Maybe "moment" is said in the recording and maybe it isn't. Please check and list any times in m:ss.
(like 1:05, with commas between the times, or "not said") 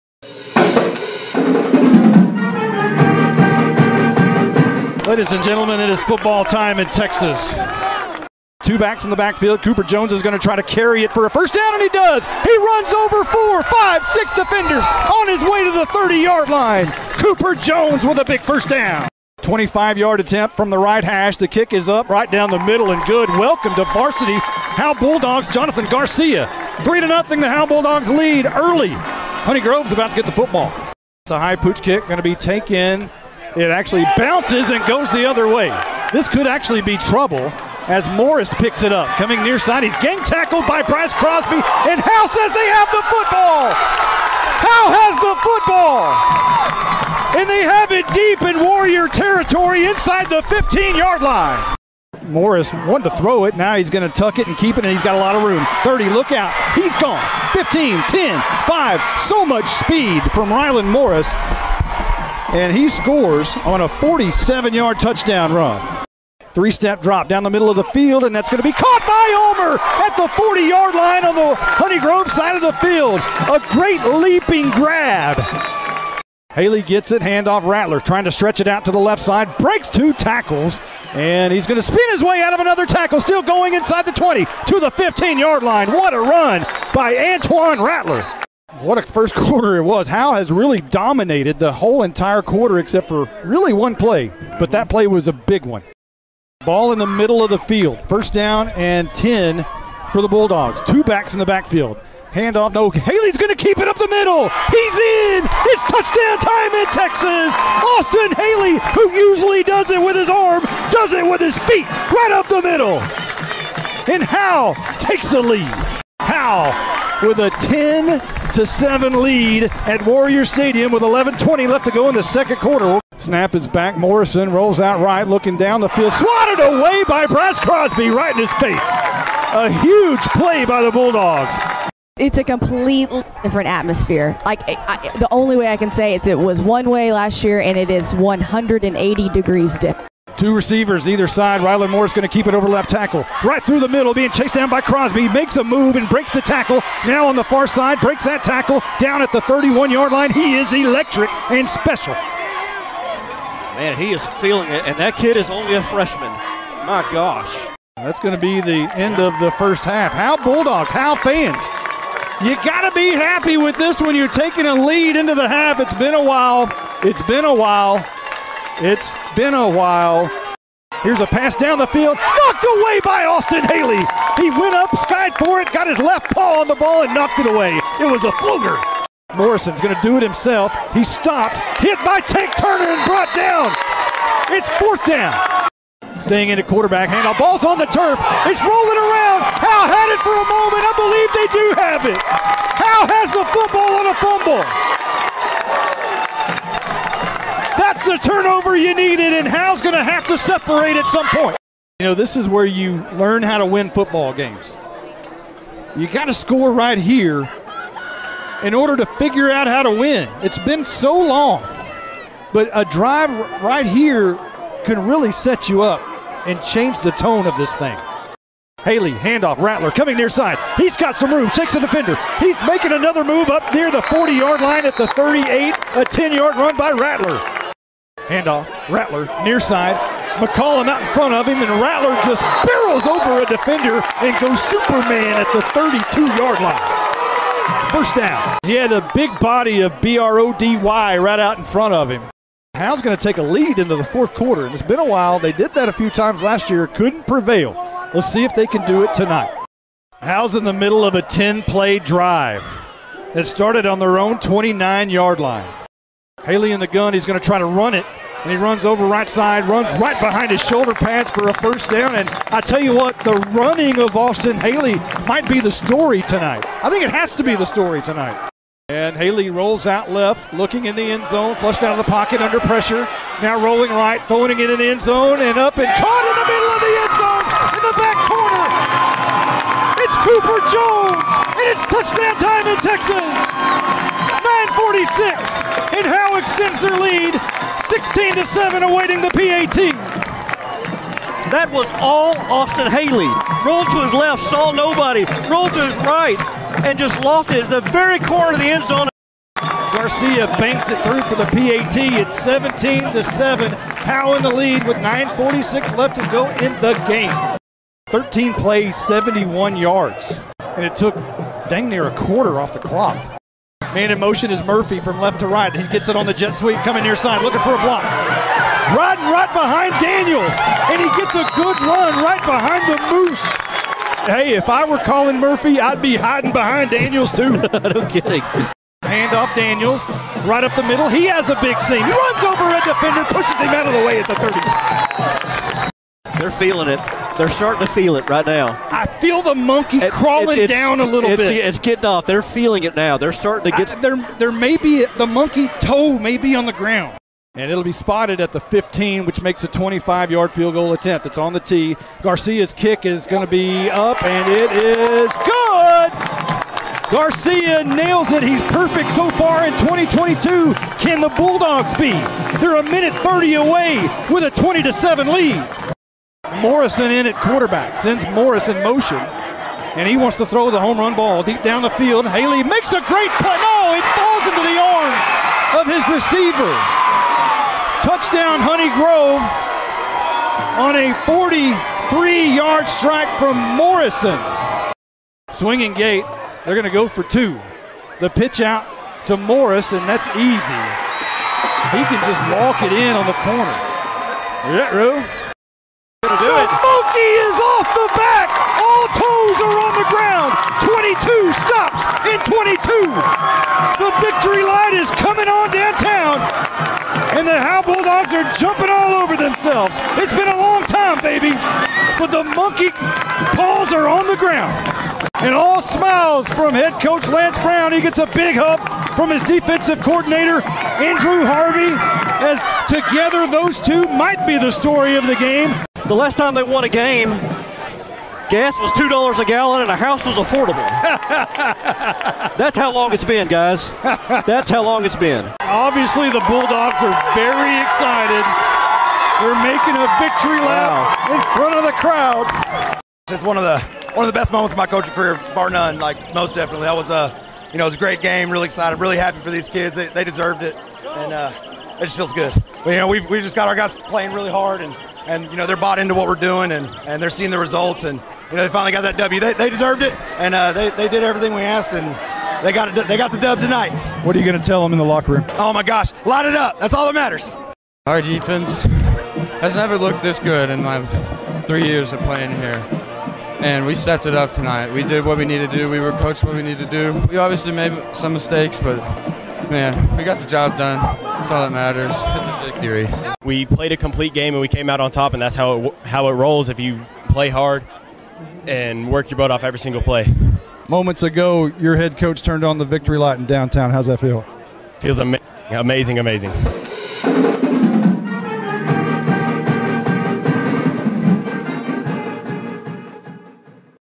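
3:10, 7:24, 8:10.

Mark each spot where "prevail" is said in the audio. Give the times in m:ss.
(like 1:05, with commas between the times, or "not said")
4:07.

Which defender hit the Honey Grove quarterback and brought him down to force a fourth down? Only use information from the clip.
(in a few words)
Tank Turner.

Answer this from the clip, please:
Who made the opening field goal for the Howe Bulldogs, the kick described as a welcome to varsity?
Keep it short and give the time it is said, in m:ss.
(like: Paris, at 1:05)
Jonathan Garcia, at 0:25.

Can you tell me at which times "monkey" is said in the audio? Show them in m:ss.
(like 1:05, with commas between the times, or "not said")
5:39, 5:45, 6:36, 6:52.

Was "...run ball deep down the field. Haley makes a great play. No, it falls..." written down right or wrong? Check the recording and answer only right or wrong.
right.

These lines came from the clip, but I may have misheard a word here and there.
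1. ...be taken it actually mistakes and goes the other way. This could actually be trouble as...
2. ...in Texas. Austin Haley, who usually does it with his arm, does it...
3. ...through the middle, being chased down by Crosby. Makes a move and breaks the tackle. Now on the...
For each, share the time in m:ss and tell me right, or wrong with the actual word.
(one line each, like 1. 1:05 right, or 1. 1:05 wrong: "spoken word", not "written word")
1. 0:32 wrong: "bounces", not "mistakes"
2. 1:46 right
3. 2:23 right.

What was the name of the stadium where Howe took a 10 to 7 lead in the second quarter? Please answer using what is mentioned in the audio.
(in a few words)
Warrior Stadium.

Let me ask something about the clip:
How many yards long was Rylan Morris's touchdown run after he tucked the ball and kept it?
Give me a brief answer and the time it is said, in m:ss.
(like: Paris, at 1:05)
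47, at 1:03.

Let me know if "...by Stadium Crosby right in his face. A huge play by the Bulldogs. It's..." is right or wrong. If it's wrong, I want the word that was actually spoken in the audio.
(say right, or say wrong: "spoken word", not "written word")
wrong: "Brad", not "Stadium".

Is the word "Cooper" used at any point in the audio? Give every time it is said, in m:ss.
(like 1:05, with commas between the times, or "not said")
0:09, 0:17, 4:40.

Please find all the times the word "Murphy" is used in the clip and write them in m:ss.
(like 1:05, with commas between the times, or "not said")
5:14, 5:25.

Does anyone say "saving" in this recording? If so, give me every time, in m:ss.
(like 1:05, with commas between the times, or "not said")
not said.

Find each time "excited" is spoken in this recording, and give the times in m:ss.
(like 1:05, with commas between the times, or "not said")
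7:17, 7:28.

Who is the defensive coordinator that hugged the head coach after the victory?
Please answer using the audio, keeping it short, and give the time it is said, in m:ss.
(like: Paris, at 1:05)
Andrew Harvey, at 7:01.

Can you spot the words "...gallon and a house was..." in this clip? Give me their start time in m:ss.
7:09.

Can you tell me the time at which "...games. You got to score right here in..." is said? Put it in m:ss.
3:24.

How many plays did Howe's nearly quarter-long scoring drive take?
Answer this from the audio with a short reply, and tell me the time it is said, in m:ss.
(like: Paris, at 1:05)
13, at 5:08.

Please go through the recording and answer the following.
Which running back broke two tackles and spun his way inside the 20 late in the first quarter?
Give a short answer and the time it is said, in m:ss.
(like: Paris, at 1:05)
Antoine Rattler, at 1:27.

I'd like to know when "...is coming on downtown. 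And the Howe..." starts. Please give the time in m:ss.
6:44.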